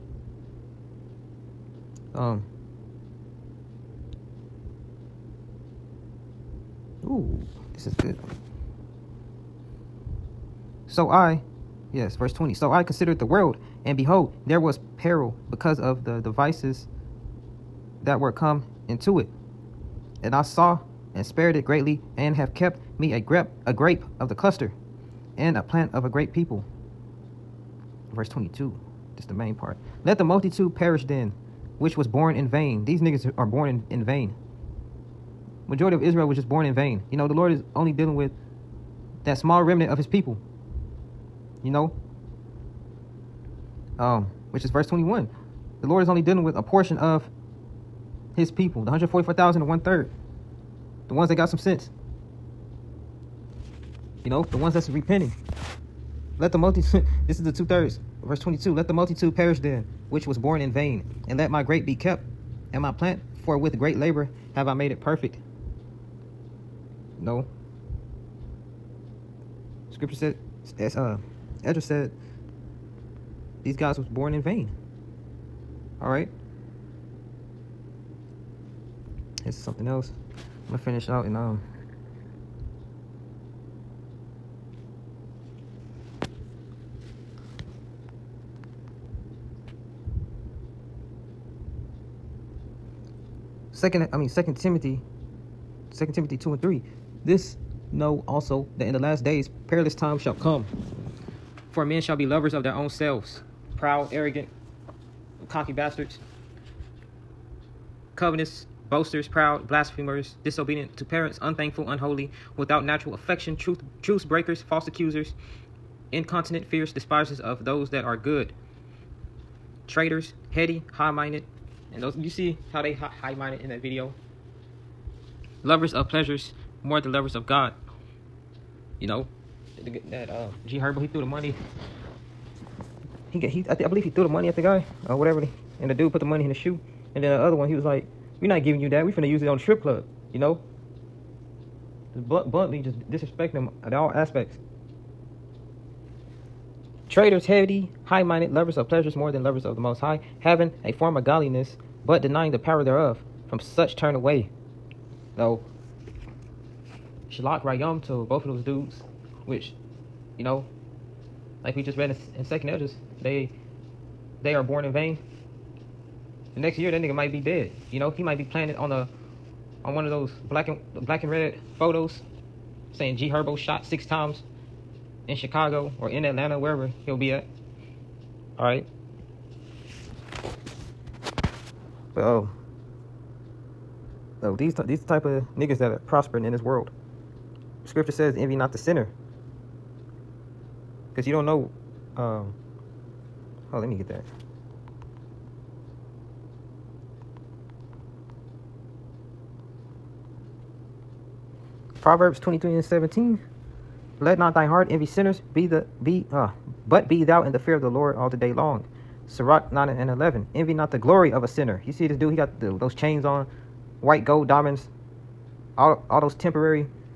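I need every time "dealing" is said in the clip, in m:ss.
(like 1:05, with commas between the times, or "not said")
0:37, 0:46.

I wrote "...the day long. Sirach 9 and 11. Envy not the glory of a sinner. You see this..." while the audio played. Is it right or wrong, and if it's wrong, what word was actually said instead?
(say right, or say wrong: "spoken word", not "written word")
right.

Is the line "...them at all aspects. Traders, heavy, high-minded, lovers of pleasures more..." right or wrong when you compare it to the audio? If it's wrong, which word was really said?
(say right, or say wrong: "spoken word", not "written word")
right.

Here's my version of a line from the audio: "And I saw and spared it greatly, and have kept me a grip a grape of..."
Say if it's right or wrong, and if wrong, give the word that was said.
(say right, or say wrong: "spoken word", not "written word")
right.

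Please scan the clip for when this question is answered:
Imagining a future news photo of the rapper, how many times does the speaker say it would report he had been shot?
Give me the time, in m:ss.
2:53.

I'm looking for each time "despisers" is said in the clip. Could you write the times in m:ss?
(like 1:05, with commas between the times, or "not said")
1:56.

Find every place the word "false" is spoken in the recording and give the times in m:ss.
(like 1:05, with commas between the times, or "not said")
1:54.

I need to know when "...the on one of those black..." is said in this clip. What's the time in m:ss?
2:48.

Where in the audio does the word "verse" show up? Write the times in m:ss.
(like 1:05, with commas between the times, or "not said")
0:12, 0:28, 0:44, 0:58.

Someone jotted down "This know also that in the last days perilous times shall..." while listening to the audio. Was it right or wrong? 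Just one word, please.
right.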